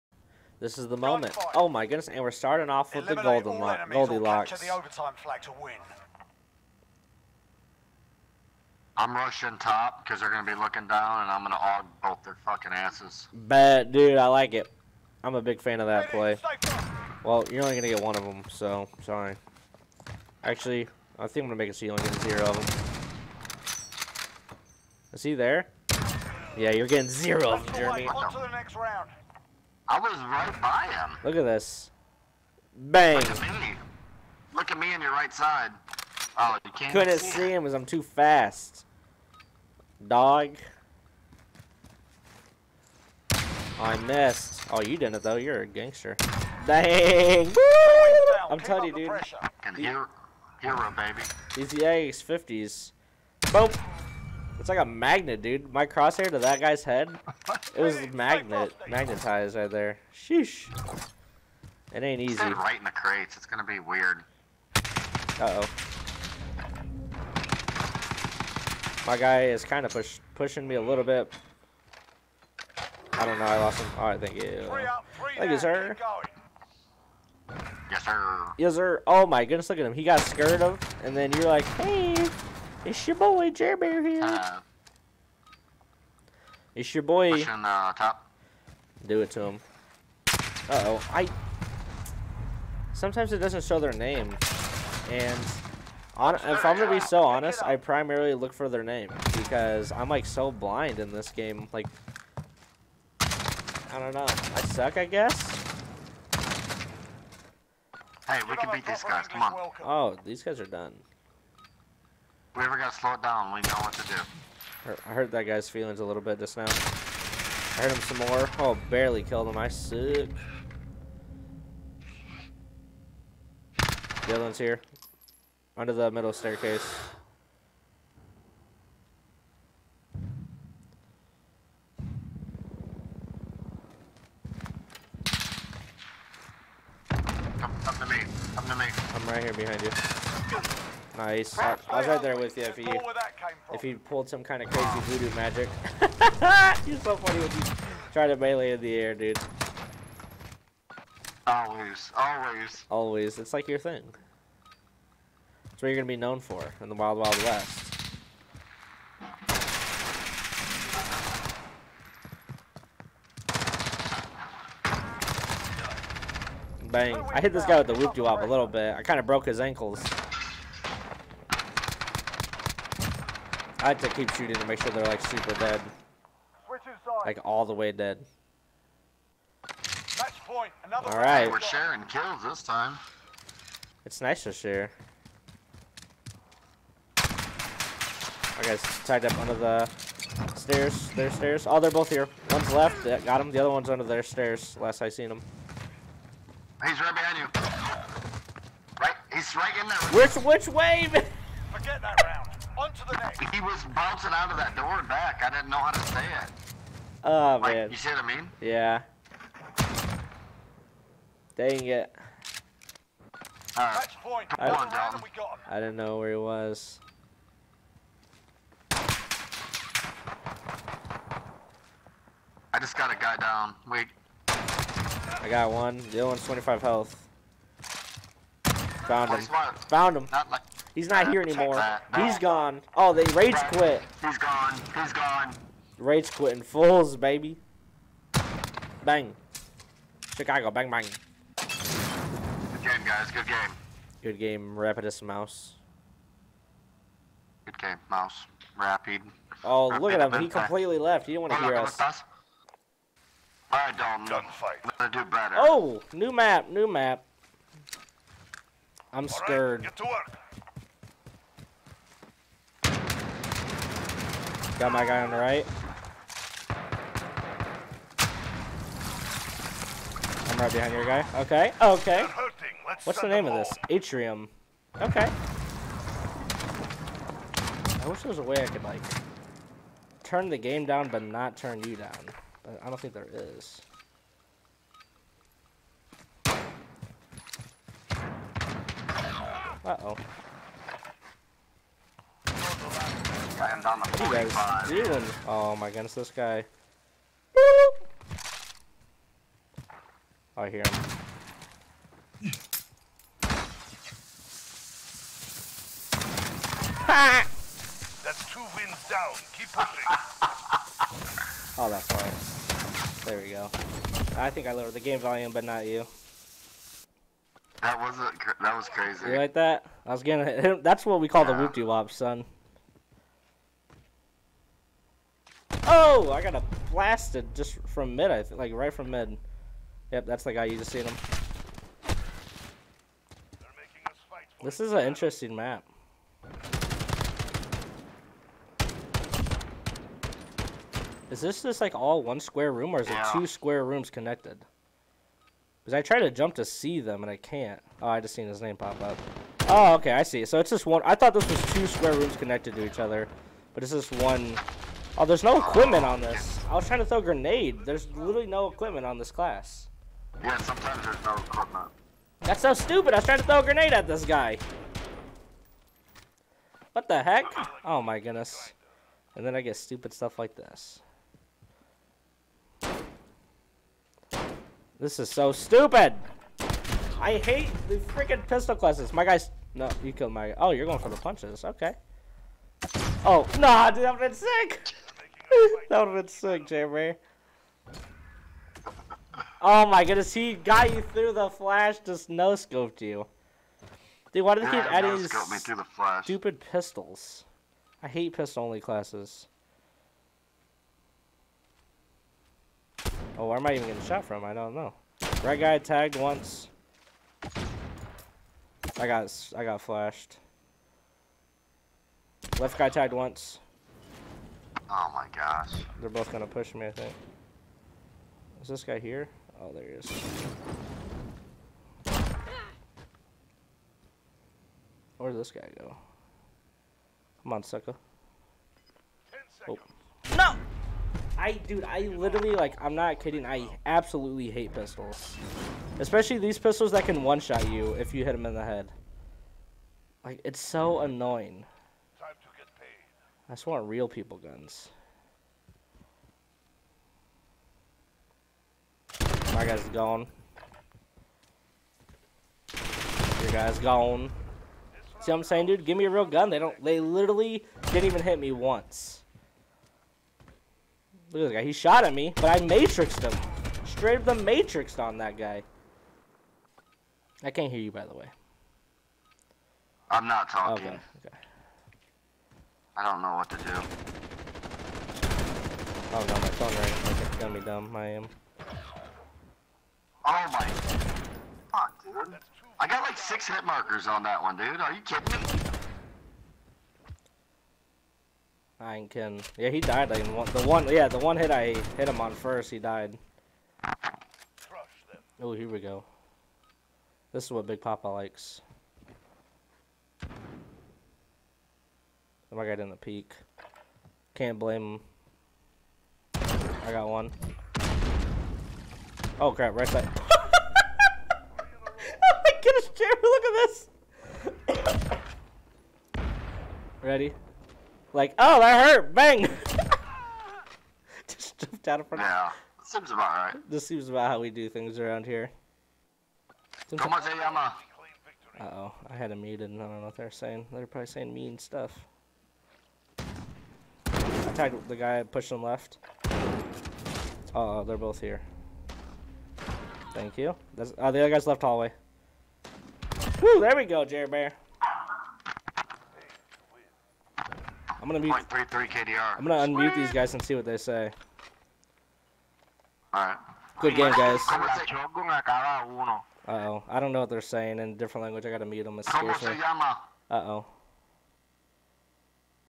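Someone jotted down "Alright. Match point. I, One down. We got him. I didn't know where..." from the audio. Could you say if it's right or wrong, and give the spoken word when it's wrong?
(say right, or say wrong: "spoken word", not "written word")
right.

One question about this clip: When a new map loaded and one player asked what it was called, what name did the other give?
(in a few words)
Atrium.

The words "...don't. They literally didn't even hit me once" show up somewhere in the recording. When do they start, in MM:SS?
07:36.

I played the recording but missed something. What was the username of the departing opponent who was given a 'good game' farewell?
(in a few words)
Rapidus Mouse.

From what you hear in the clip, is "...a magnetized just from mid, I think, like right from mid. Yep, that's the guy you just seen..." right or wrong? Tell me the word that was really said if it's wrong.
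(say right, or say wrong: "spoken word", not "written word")
wrong: "blasted", not "magnetized".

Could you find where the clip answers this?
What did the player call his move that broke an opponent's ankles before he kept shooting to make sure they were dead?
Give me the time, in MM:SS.
02:47.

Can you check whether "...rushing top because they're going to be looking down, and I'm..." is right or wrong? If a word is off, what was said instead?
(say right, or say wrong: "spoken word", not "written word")
right.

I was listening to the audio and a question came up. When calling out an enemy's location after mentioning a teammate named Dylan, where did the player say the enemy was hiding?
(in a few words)
Under the middle staircase.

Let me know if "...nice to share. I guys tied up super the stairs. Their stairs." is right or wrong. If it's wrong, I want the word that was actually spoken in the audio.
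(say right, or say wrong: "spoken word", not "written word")
wrong: "under", not "super".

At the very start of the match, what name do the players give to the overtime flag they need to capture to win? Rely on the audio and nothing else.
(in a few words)
Golden lock.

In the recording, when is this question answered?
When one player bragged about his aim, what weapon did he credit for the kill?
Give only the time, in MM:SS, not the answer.
00:51.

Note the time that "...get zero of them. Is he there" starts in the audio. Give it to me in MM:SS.
00:22.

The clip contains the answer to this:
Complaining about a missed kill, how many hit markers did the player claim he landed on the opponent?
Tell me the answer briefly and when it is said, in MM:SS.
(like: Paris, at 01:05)
6, at 08:03.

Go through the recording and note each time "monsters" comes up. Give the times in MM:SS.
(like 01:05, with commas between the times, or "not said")
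not said.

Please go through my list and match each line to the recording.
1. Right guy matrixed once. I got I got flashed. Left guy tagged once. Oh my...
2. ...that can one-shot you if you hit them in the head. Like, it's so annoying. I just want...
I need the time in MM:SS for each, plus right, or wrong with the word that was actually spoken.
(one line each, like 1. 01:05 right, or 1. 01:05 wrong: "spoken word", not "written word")
1. 06:45 wrong: "tagged", not "matrixed"
2. 07:16 right.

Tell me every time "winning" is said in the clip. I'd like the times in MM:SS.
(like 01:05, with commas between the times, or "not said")
not said.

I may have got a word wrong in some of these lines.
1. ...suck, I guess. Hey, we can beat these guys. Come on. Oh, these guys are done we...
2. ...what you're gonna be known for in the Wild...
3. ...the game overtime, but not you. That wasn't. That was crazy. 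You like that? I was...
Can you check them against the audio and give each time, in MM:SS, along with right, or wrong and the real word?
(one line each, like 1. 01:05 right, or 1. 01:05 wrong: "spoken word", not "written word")
1. 01:44 right
2. 02:35 right
3. 05:14 wrong: "volume", not "overtime".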